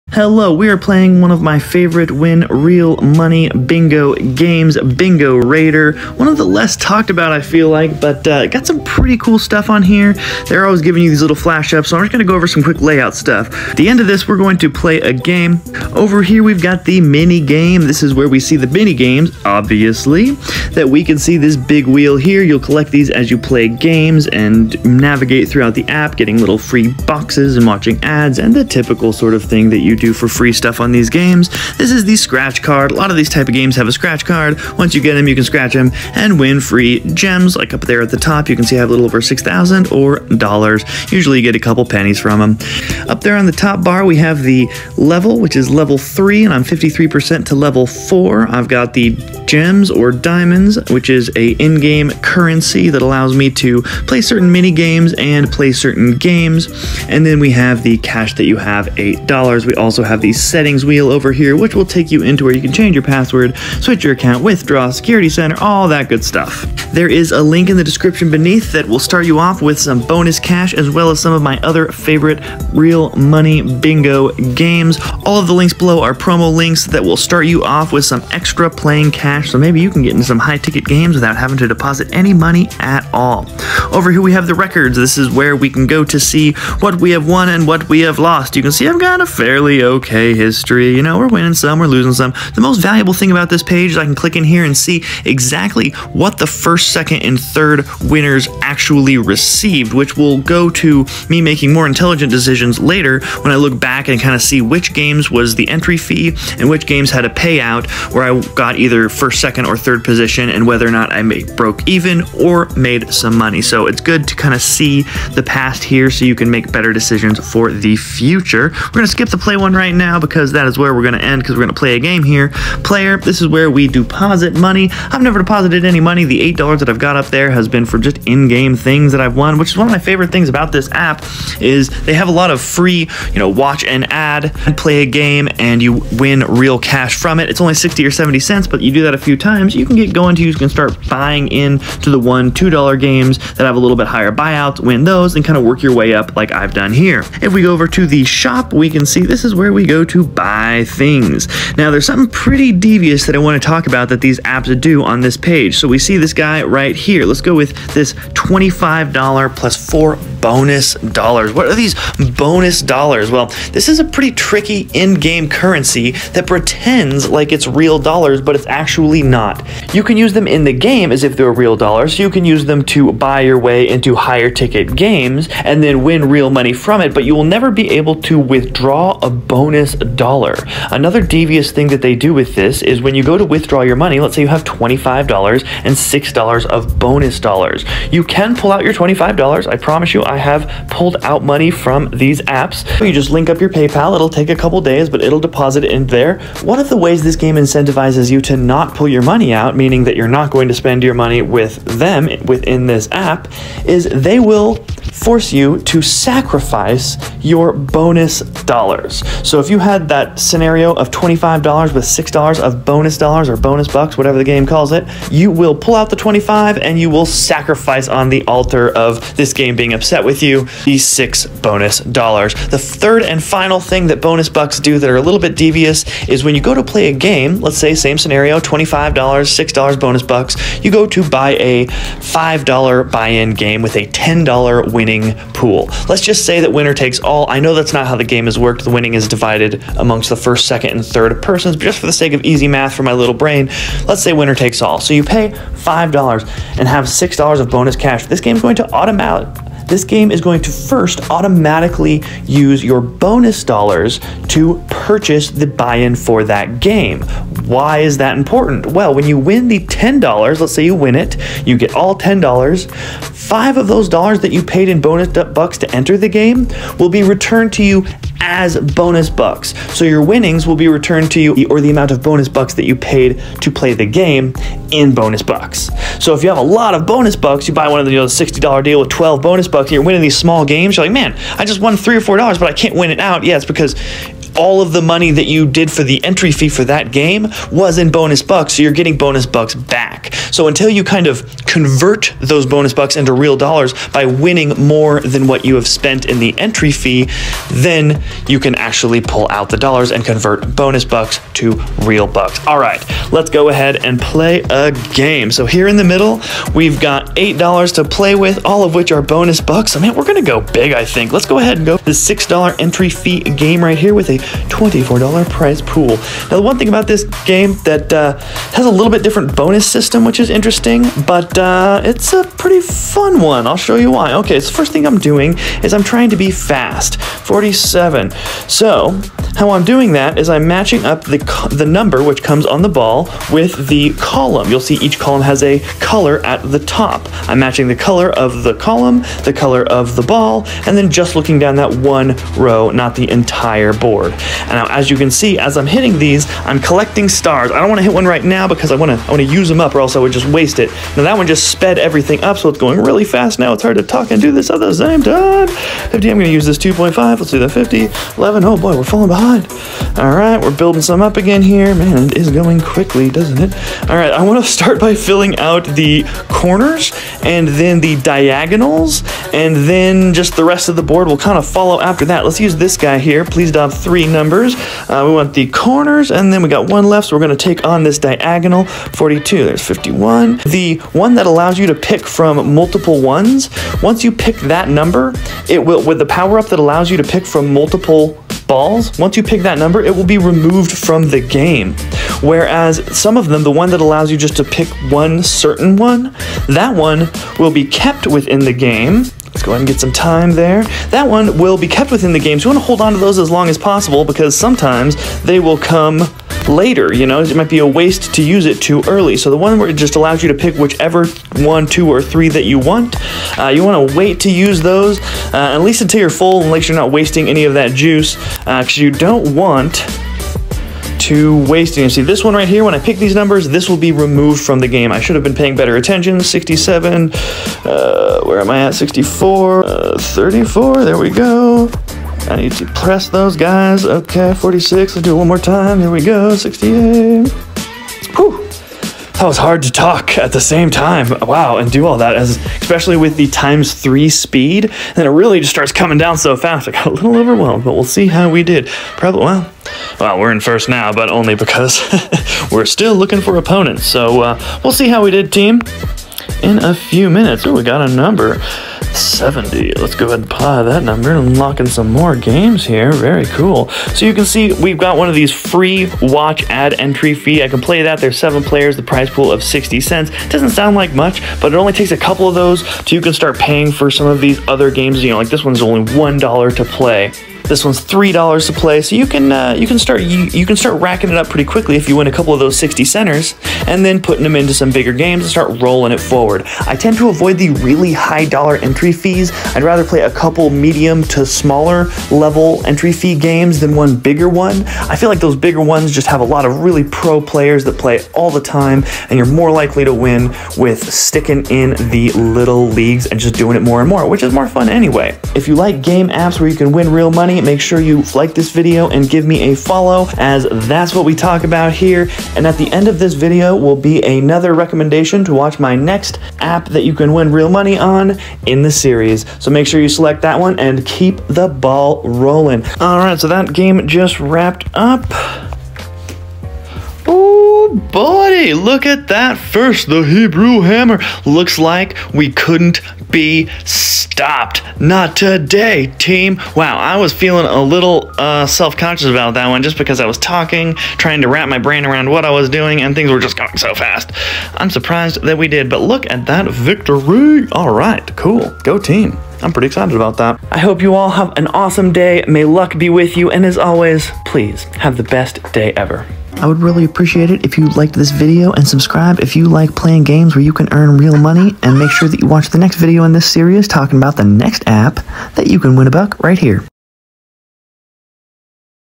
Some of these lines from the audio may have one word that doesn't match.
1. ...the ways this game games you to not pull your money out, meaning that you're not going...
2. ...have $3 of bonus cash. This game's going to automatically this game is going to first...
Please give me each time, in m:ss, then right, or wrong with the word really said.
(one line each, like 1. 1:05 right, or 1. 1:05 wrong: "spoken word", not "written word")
1. 3:16 wrong: "incentivizes", not "games"
2. 4:06 wrong: "6", not "3".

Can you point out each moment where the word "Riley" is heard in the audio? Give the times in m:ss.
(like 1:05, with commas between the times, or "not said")
not said.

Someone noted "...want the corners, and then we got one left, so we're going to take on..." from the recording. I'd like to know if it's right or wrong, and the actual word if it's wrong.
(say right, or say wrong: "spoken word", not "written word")
right.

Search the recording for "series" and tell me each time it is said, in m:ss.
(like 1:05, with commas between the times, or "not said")
8:38, 9:23.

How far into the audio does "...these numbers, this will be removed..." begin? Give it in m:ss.
7:03.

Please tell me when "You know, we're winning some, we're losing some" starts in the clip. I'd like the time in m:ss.
1:30.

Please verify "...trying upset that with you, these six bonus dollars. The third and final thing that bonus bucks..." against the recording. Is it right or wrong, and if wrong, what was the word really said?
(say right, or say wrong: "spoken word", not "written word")
wrong: "being", not "trying".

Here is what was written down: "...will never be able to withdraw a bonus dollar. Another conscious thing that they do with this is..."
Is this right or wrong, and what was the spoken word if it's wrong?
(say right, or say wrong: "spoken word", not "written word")
wrong: "devious", not "conscious".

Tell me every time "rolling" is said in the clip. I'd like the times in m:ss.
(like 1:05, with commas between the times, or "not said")
8:05, 8:42.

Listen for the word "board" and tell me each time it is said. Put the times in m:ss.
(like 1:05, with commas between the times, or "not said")
5:43, 6:11.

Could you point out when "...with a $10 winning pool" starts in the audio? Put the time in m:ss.
3:53.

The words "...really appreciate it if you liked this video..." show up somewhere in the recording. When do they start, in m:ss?
9:16.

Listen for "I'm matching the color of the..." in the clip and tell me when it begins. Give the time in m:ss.
5:37.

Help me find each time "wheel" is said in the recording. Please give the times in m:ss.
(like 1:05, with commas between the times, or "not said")
0:21, 1:00.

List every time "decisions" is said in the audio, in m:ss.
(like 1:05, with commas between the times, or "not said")
1:42, 1:56.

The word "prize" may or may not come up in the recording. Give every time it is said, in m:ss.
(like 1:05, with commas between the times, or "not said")
5:15, 7:49.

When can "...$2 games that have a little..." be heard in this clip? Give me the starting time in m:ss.
2:22.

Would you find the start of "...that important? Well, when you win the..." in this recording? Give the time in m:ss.
4:18.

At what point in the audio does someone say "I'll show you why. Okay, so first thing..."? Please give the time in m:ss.
5:23.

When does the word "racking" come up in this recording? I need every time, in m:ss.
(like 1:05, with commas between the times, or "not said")
8:01.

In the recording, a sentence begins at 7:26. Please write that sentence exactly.
I got a little overwhelmed, but we'll see how we did.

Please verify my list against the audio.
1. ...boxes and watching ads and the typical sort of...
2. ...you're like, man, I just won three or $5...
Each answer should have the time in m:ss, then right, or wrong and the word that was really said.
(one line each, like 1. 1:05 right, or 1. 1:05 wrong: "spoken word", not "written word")
1. 0:27 right
2. 4:40 wrong: "4", not "5".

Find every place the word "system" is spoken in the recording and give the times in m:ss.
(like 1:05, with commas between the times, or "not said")
5:19.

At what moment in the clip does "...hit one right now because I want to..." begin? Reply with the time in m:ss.
5:48.